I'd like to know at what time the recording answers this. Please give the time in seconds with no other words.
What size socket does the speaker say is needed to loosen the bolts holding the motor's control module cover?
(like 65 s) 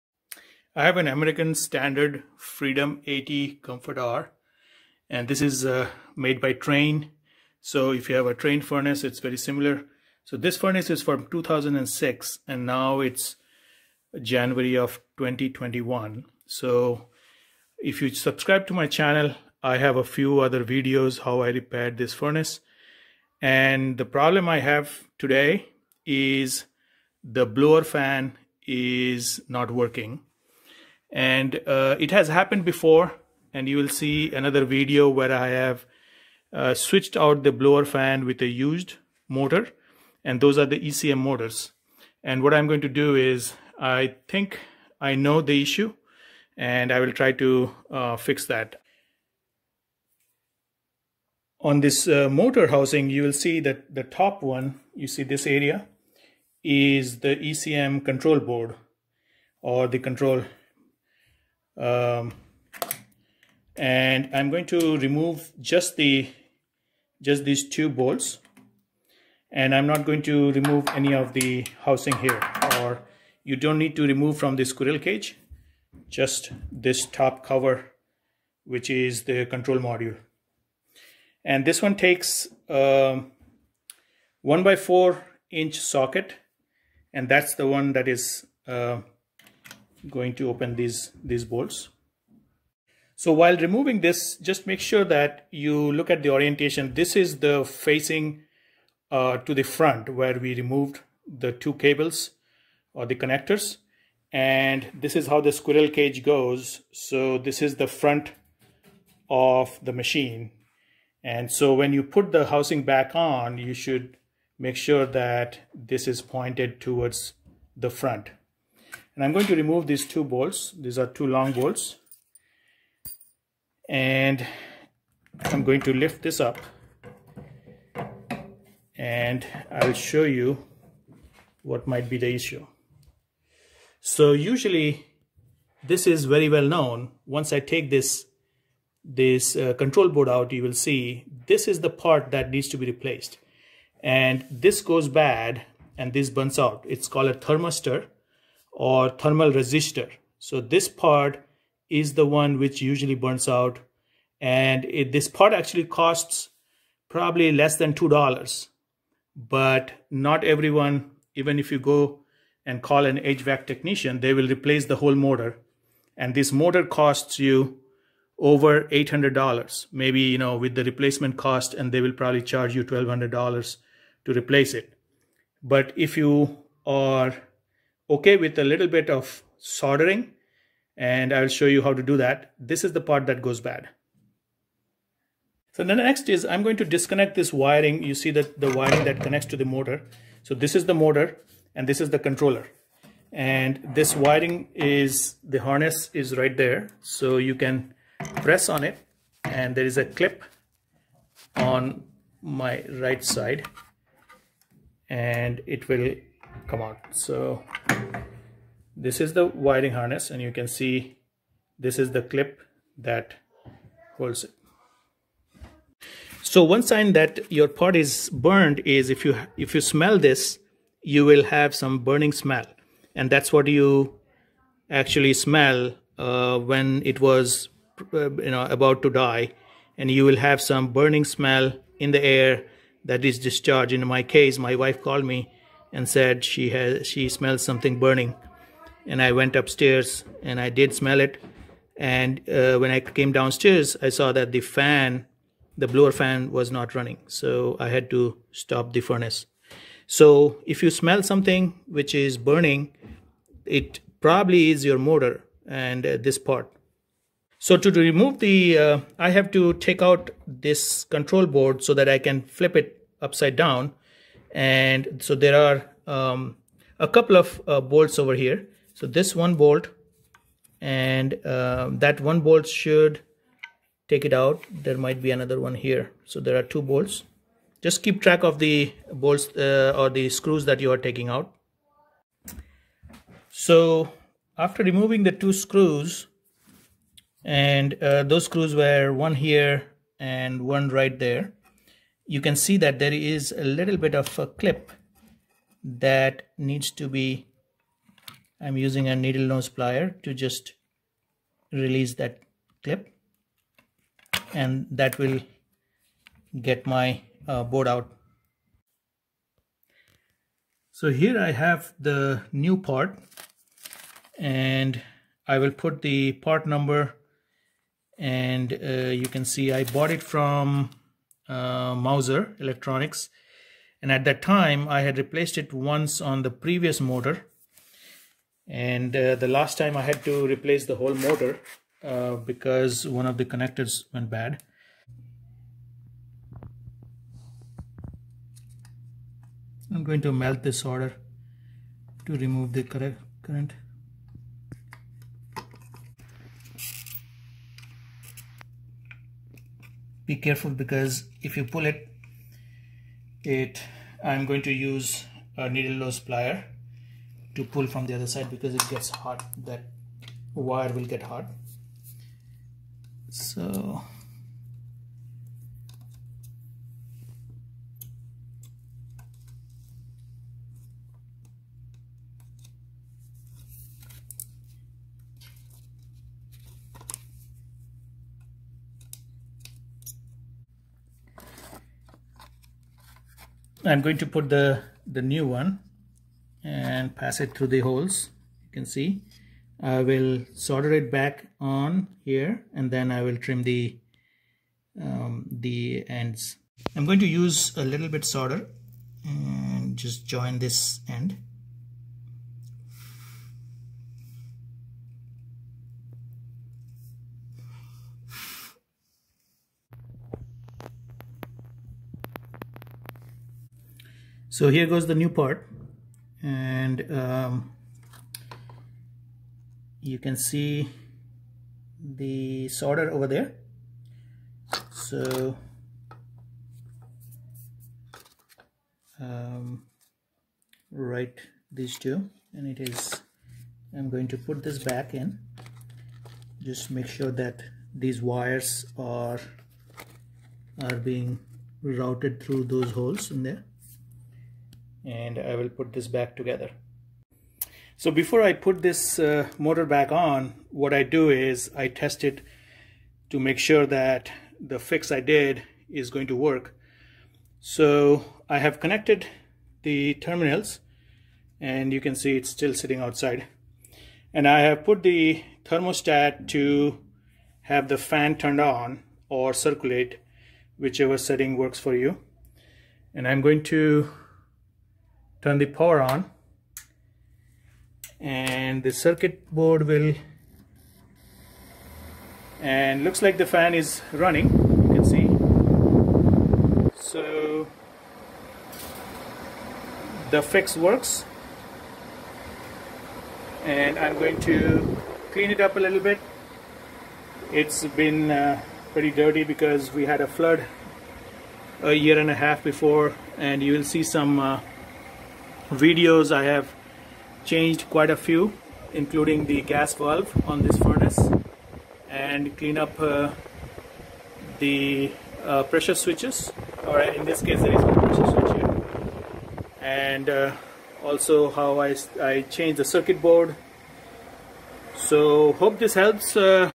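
84 s.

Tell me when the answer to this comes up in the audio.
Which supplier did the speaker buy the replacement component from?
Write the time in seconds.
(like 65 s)
321 s.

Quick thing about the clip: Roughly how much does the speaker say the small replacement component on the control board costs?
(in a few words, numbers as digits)
Less than $2.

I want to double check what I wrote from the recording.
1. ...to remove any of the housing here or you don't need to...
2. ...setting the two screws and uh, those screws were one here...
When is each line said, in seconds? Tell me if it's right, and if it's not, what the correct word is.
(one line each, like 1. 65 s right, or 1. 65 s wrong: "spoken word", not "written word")
1. 70 s right
2. 284 s wrong: "removing", not "setting".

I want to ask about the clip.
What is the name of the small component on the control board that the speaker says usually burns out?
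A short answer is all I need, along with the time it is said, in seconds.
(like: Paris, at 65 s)
Thermistor, at 147 s.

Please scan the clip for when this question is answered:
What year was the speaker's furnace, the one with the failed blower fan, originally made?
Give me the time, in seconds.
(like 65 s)
11 s.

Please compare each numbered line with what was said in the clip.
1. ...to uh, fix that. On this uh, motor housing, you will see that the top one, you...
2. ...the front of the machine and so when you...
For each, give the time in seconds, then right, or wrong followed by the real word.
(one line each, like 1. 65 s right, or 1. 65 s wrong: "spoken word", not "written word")
1. 47 s right
2. 107 s right.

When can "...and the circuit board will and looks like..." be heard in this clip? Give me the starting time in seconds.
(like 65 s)
478 s.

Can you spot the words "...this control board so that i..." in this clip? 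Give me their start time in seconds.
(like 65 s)
260 s.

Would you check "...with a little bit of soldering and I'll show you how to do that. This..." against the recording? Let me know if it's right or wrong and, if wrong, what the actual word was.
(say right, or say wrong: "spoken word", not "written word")
right.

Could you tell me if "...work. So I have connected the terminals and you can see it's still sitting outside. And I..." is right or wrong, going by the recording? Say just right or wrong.
right.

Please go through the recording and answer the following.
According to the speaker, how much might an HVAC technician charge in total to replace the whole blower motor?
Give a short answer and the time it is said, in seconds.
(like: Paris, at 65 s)
$1,200, at 172 s.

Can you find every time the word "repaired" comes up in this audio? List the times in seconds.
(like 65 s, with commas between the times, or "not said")
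21 s.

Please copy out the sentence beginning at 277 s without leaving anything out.
Just keep track of the bolts uh, or the screws that you are taking out.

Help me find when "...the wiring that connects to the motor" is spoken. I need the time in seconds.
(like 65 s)
188 s.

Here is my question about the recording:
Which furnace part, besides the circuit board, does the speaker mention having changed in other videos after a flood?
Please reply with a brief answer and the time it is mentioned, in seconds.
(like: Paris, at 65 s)
Gas valve, at 509 s.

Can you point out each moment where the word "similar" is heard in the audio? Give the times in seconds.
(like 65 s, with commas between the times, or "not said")
9 s.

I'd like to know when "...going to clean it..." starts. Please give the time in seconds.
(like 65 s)
494 s.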